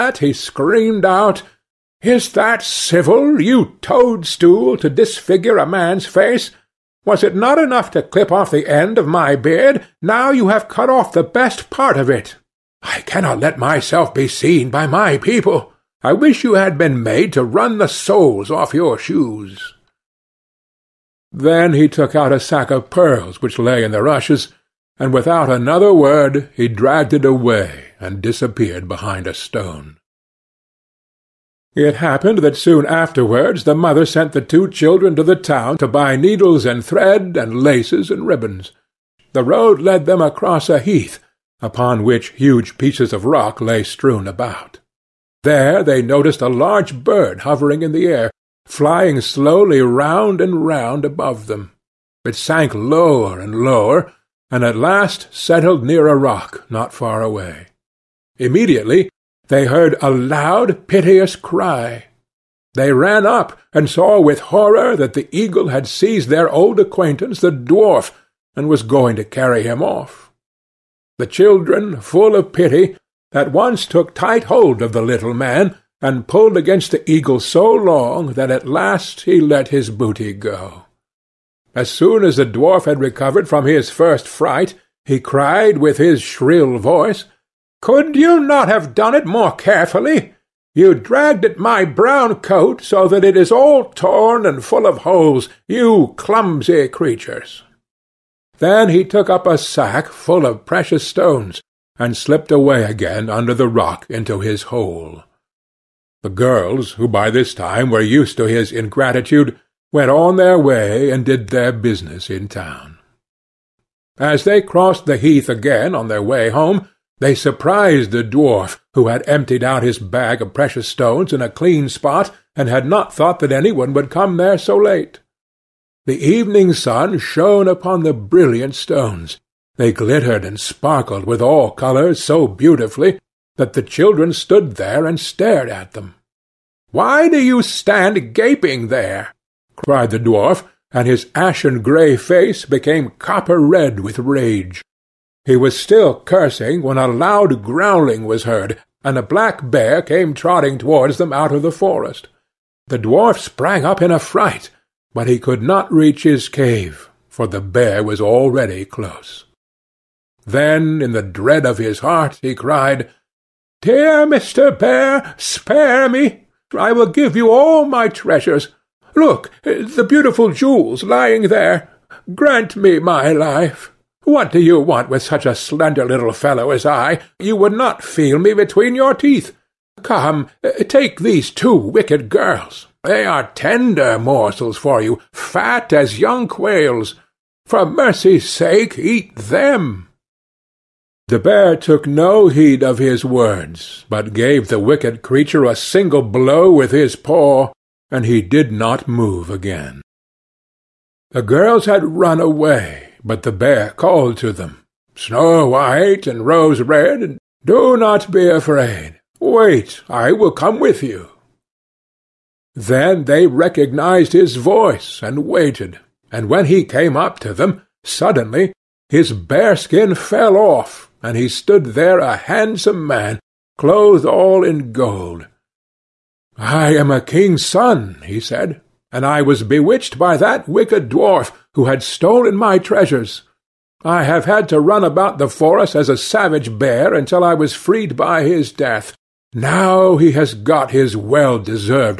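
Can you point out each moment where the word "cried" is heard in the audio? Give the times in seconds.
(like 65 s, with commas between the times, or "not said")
85 s, 139 s, 162 s.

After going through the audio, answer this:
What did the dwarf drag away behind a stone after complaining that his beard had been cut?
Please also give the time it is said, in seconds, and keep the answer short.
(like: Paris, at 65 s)
A sack of pearls, at 22 s.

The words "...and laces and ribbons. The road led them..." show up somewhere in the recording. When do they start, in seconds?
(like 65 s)
37 s.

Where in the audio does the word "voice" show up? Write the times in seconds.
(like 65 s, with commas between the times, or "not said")
86 s, 214 s.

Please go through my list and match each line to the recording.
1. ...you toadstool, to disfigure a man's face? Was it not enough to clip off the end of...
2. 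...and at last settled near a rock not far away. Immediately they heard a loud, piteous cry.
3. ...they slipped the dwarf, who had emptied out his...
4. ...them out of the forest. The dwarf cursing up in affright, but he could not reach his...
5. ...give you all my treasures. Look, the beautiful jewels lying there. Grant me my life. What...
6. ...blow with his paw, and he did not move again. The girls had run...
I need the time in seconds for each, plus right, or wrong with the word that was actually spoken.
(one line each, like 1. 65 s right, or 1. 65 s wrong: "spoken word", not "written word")
1. 3 s right
2. 54 s right
3. 117 s wrong: "surprised", not "slipped"
4. 151 s wrong: "sprang", not "cursing"
5. 167 s right
6. 196 s right.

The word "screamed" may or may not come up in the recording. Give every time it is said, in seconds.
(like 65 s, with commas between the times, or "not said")
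0 s.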